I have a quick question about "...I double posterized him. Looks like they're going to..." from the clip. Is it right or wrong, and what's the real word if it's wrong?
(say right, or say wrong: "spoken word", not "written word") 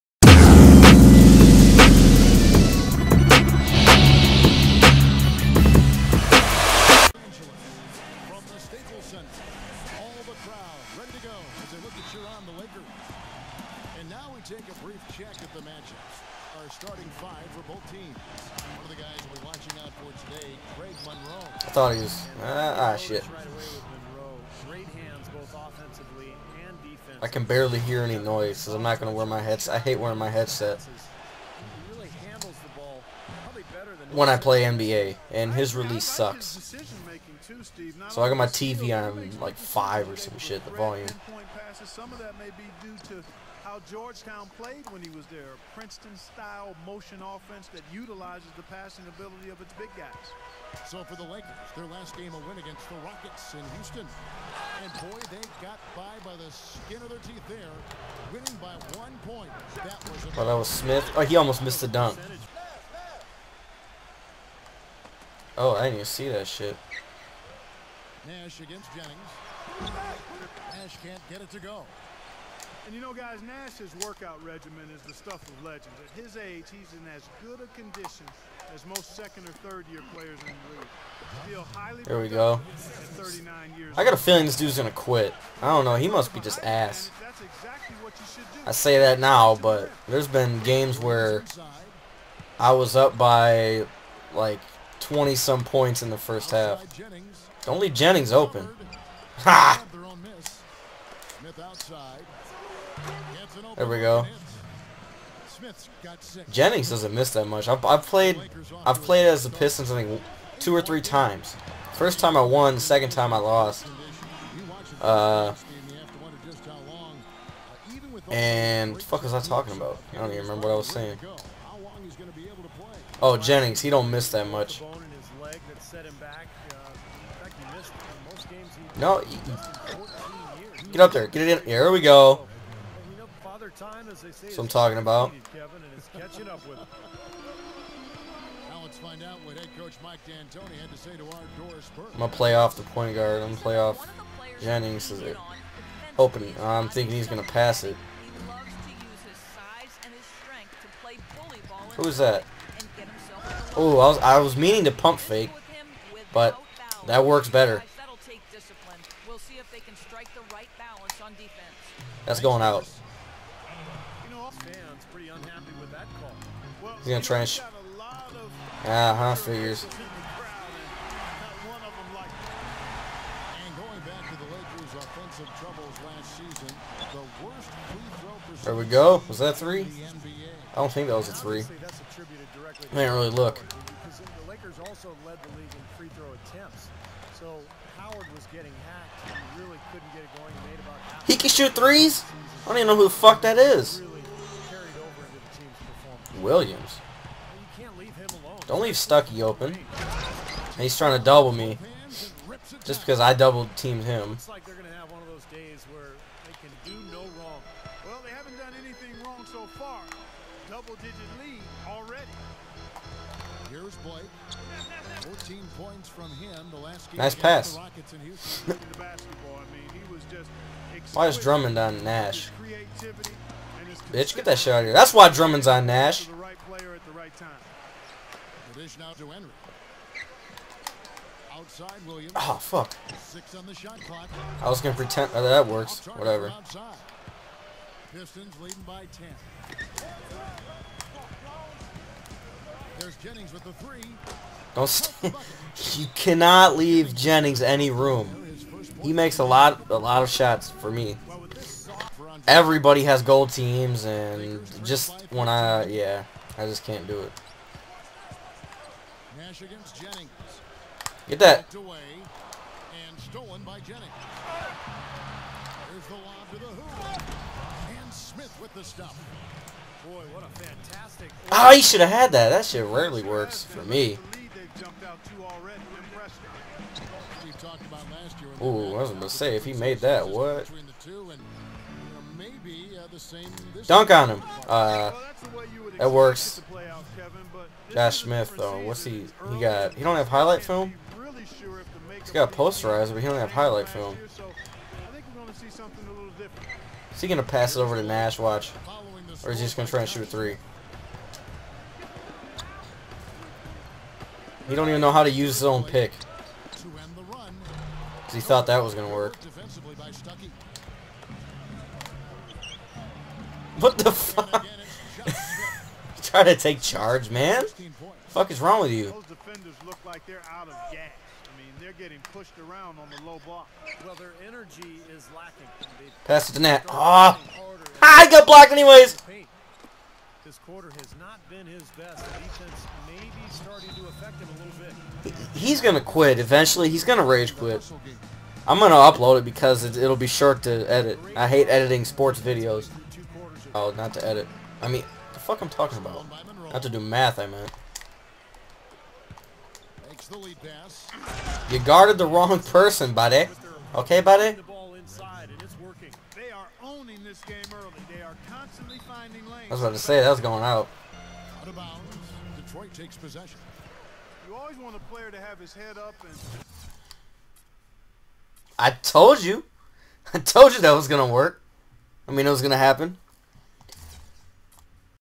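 wrong: "teamed", not "posterized".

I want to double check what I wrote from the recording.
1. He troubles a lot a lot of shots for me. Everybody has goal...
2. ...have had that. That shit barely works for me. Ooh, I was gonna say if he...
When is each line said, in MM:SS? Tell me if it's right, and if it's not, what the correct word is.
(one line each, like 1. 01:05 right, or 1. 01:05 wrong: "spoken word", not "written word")
1. 04:09 wrong: "makes", not "troubles"
2. 04:32 wrong: "rarely", not "barely".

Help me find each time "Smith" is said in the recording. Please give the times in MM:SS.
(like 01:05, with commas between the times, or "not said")
01:00, 01:41, 04:48.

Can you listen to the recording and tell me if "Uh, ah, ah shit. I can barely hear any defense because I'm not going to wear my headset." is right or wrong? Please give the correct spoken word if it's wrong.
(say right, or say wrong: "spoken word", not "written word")
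wrong: "noise", not "defense".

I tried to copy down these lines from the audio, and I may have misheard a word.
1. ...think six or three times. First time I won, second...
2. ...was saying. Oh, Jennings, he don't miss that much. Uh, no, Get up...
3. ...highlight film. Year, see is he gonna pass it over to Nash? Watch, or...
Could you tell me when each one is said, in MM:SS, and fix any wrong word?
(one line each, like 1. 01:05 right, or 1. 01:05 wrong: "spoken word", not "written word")
1. 01:50 wrong: "two", not "six"
2. 02:00 right
3. 04:53 right.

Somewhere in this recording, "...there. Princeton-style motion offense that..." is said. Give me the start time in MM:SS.
00:45.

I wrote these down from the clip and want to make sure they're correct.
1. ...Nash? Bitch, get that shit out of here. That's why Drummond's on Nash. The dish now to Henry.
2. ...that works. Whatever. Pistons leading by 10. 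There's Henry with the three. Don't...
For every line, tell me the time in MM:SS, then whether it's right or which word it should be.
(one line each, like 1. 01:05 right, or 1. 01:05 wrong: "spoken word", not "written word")
1. 03:42 right
2. 03:55 wrong: "Jennings", not "Henry".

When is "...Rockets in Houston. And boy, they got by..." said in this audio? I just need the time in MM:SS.
00:53.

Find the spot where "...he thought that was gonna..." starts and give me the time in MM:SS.
05:08.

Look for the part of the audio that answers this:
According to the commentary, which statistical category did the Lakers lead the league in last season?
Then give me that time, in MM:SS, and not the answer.
03:05.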